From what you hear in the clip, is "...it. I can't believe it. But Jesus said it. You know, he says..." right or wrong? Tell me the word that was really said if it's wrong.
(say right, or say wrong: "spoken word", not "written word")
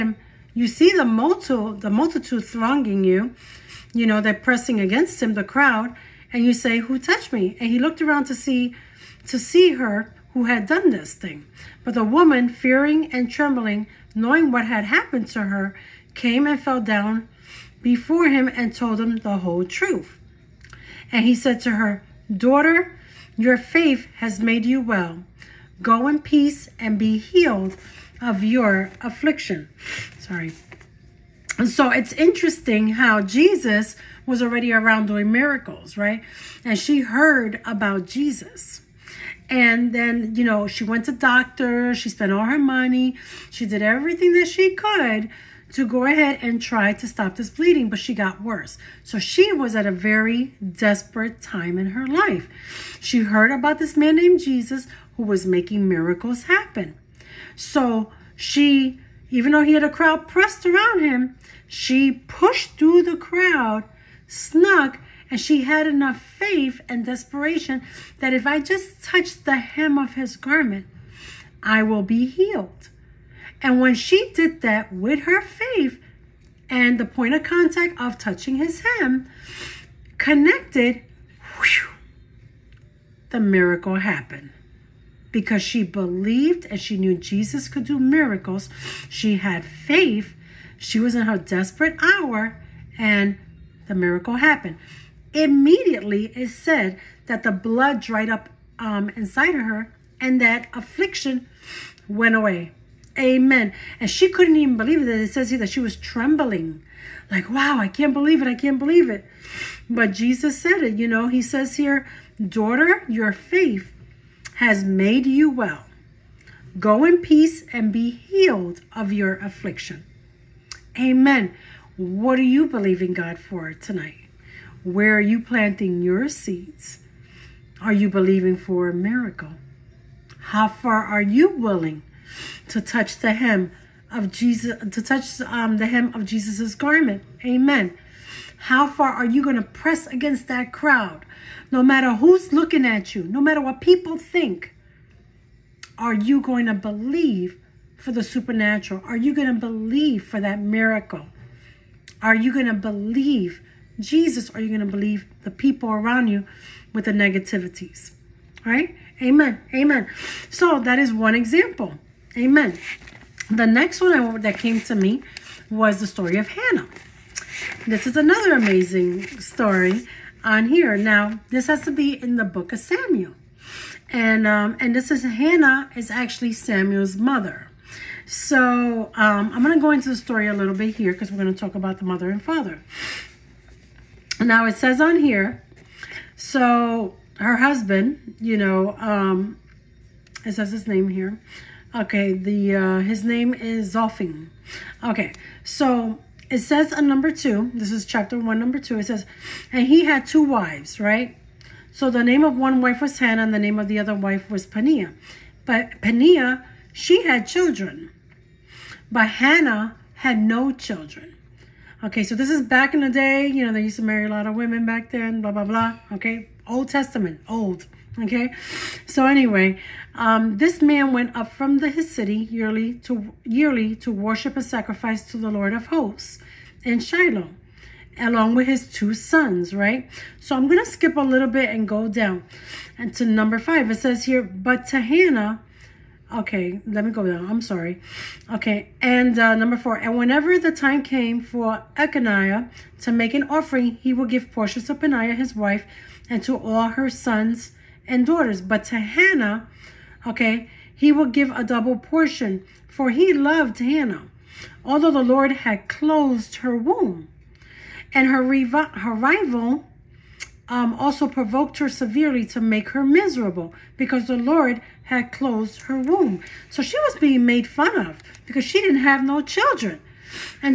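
right.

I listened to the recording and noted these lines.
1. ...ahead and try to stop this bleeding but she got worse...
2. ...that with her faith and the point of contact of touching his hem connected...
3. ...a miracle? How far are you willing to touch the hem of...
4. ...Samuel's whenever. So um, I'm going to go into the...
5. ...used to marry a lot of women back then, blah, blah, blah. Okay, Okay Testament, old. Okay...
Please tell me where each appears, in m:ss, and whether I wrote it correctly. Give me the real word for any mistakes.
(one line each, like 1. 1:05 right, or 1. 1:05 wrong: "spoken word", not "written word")
1. 0:46 right
2. 1:14 right
3. 2:08 right
4. 2:56 wrong: "mother", not "whenever"
5. 3:33 wrong: "Old", not "Okay".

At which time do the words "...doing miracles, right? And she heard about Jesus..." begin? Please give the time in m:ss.
0:35.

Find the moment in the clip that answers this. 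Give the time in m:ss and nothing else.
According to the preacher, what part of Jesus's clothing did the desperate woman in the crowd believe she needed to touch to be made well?
1:09.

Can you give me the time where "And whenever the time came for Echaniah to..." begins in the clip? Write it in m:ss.
3:59.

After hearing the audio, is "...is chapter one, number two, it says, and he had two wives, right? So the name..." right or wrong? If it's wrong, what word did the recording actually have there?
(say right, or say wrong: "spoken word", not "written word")
right.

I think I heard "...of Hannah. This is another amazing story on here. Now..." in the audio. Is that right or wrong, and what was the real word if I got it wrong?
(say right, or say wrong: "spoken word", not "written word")
right.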